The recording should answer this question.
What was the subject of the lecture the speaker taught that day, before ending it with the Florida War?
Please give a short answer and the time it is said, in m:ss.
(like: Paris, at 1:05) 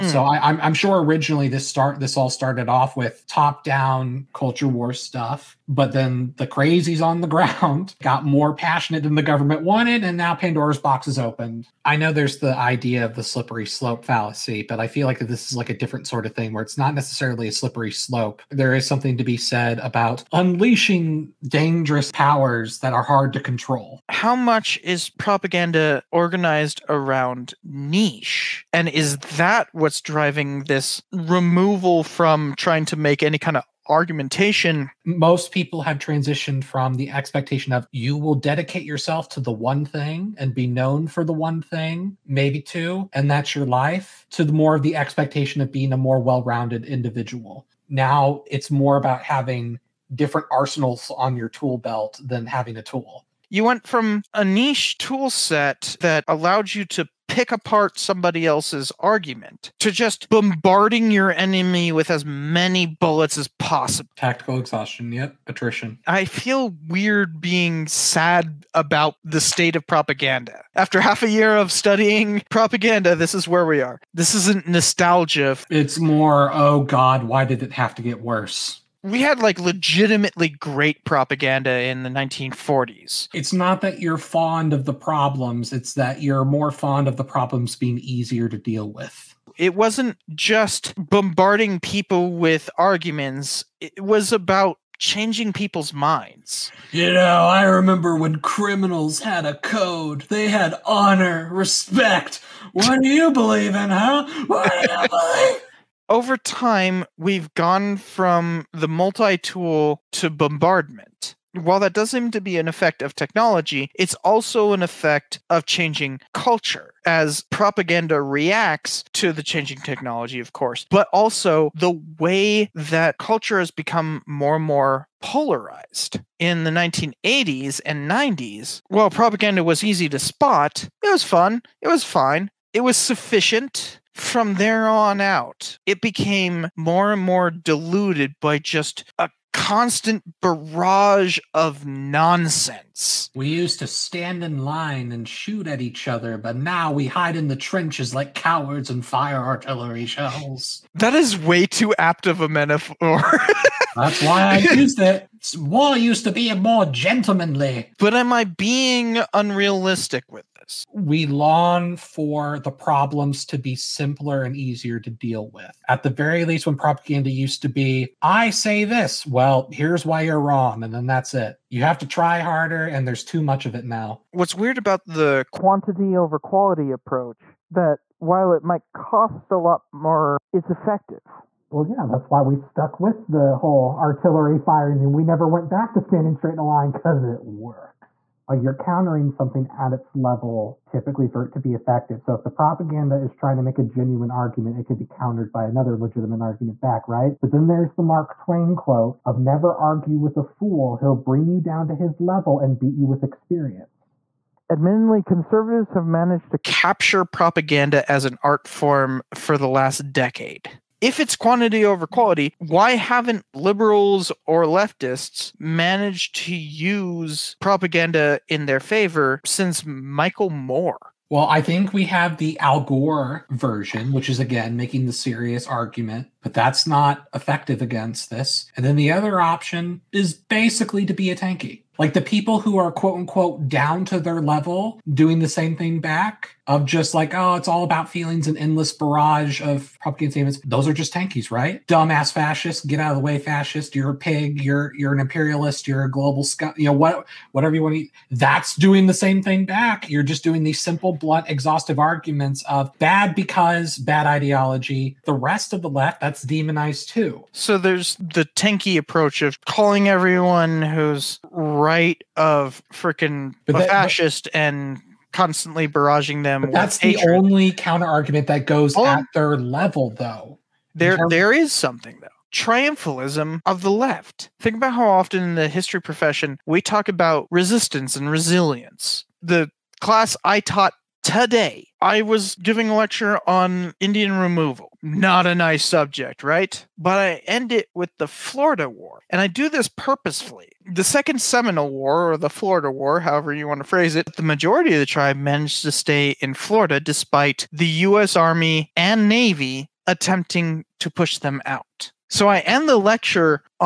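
Indian removal, at 4:43.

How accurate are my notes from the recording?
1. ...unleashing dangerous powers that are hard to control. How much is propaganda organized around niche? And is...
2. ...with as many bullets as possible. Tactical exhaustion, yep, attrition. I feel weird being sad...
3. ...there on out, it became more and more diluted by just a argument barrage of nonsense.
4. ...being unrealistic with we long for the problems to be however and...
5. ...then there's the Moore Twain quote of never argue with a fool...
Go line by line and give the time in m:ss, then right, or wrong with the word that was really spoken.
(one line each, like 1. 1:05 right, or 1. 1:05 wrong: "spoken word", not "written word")
1. 0:20 right
2. 1:01 right
3. 2:14 wrong: "constant", not "argument"
4. 2:38 wrong: "simpler", not "however"
5. 3:17 wrong: "Mark", not "Moore".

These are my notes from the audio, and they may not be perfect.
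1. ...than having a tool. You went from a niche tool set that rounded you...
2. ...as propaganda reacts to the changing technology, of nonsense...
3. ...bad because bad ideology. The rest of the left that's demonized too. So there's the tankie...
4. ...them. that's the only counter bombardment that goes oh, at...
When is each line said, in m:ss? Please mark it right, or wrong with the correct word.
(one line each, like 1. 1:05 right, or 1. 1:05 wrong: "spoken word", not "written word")
1. 0:52 wrong: "allowed", not "rounded"
2. 1:57 wrong: "course", not "nonsense"
3. 4:12 right
4. 4:26 wrong: "argument", not "bombardment".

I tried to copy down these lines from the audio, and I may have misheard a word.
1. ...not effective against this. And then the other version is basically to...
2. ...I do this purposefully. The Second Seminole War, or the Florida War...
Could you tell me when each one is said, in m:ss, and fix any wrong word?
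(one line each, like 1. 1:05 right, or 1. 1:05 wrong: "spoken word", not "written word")
1. 3:46 wrong: "option", not "version"
2. 4:49 right.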